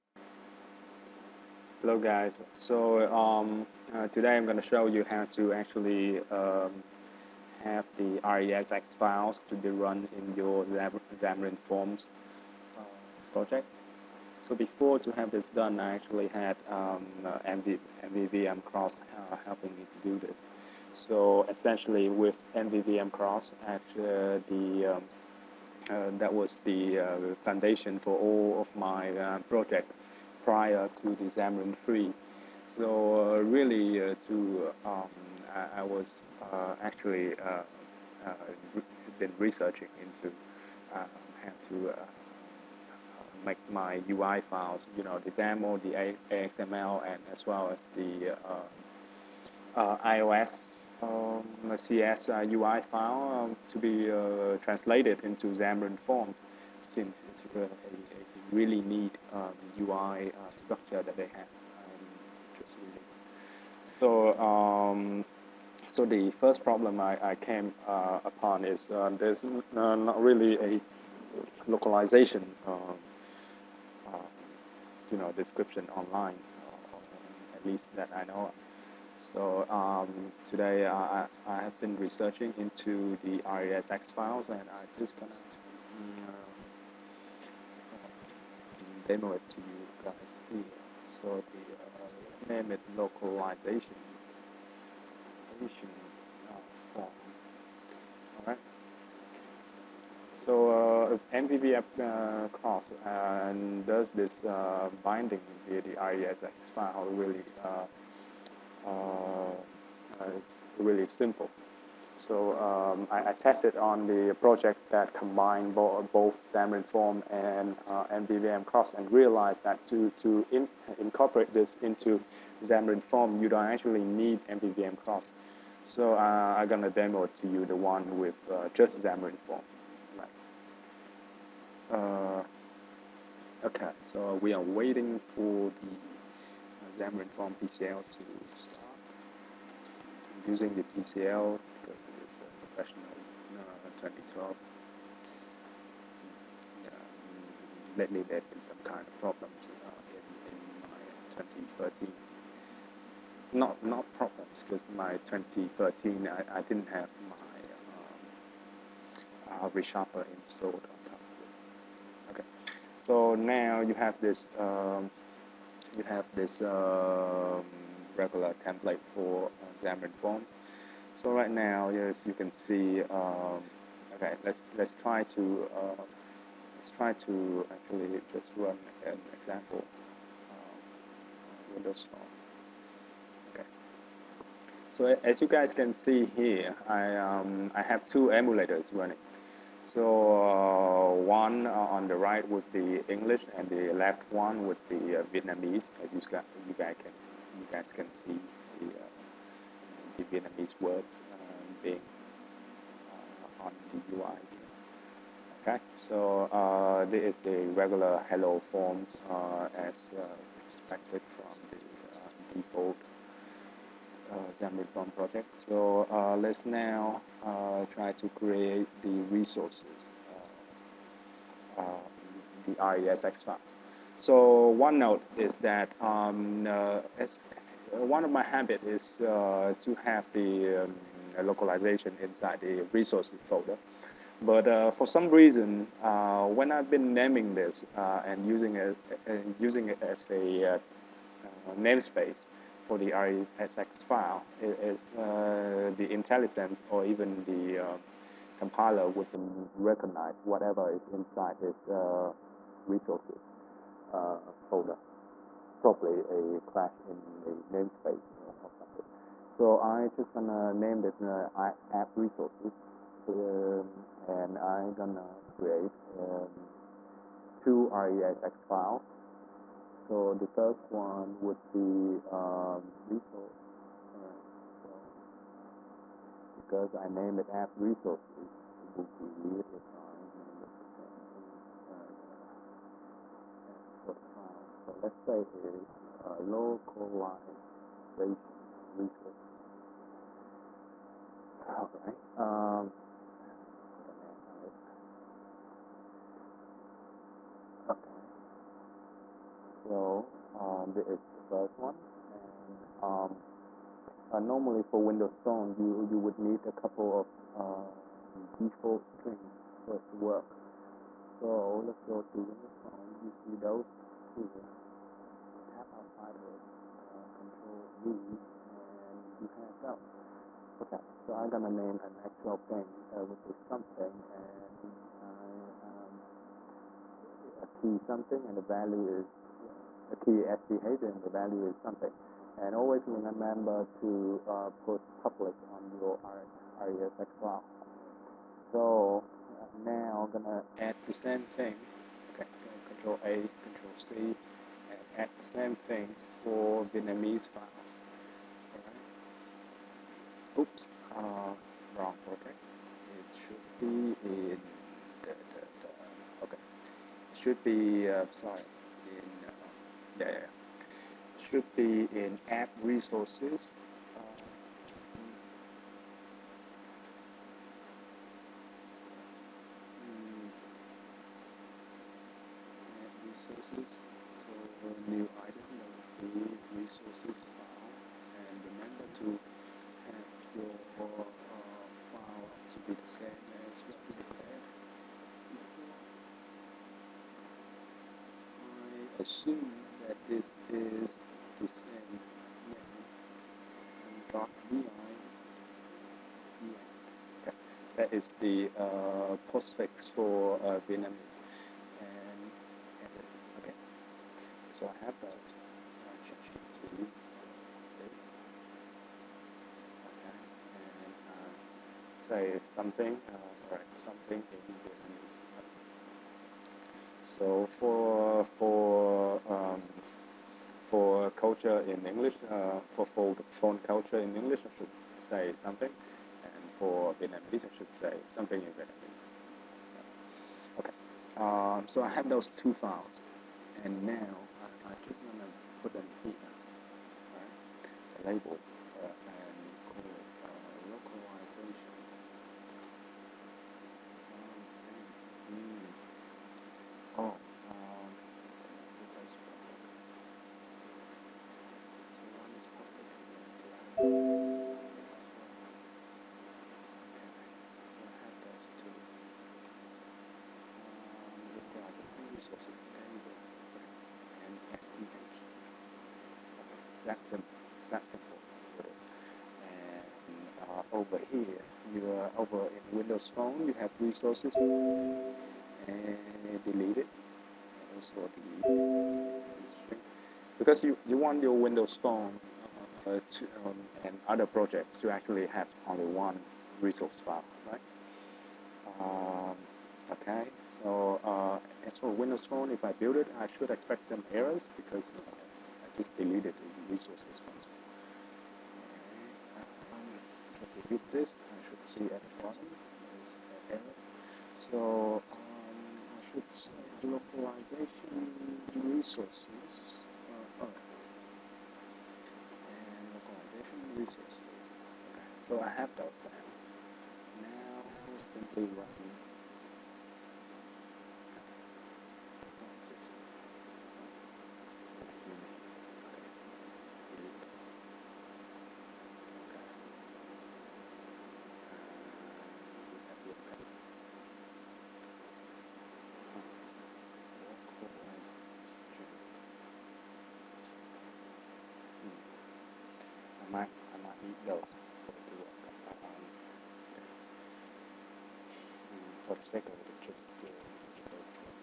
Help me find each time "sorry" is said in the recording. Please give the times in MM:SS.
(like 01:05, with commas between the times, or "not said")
05:58, 06:53.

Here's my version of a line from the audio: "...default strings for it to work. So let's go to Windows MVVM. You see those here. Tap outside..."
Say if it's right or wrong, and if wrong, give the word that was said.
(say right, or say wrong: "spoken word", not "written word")
wrong: "Phone", not "MVVM".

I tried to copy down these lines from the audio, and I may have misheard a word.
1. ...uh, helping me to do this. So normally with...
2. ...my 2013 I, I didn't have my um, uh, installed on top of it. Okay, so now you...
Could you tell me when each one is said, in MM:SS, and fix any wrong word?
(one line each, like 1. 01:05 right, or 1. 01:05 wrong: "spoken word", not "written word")
1. 00:19 wrong: "essentially", not "normally"
2. 02:34 right.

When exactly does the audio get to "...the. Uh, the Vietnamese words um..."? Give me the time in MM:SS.
03:18.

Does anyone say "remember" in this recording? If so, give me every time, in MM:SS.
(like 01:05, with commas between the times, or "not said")
05:33, 06:18.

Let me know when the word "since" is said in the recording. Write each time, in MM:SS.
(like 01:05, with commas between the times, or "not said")
00:56.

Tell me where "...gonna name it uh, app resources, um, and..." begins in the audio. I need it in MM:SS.
04:20.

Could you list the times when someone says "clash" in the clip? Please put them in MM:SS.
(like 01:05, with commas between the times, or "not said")
04:16.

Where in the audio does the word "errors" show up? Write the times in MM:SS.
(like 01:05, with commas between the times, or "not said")
08:14, 08:23.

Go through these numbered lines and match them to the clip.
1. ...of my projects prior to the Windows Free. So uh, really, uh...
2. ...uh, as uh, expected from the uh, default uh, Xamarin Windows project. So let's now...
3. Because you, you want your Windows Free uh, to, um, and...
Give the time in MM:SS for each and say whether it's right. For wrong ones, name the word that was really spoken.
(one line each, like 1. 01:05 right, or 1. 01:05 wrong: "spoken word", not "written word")
1. 00:28 wrong: "Xamarin", not "Windows"
2. 03:29 wrong: "Form", not "Windows"
3. 08:00 wrong: "Phone", not "Free".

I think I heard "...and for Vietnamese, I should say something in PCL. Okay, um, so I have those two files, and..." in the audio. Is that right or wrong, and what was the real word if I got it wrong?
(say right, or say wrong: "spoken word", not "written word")
wrong: "Vietnamese", not "PCL".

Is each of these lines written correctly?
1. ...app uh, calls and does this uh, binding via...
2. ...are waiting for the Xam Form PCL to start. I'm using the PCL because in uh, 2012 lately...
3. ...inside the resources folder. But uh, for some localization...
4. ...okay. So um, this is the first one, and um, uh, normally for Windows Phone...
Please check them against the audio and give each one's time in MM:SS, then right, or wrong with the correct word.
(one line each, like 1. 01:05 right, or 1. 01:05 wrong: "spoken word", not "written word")
1. 01:41 right
2. 02:14 right
3. 03:52 wrong: "reason", not "localization"
4. 04:57 right.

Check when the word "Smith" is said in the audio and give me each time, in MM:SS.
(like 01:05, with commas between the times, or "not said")
not said.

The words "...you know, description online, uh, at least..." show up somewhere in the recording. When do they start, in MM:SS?
01:15.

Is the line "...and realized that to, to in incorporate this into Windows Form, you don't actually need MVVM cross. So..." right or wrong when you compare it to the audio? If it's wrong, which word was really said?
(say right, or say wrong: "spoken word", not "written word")
wrong: "Xam", not "Windows".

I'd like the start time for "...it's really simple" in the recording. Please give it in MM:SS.
01:50.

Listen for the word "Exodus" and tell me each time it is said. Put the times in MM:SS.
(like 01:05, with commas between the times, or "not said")
not said.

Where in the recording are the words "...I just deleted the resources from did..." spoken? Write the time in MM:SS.
08:15.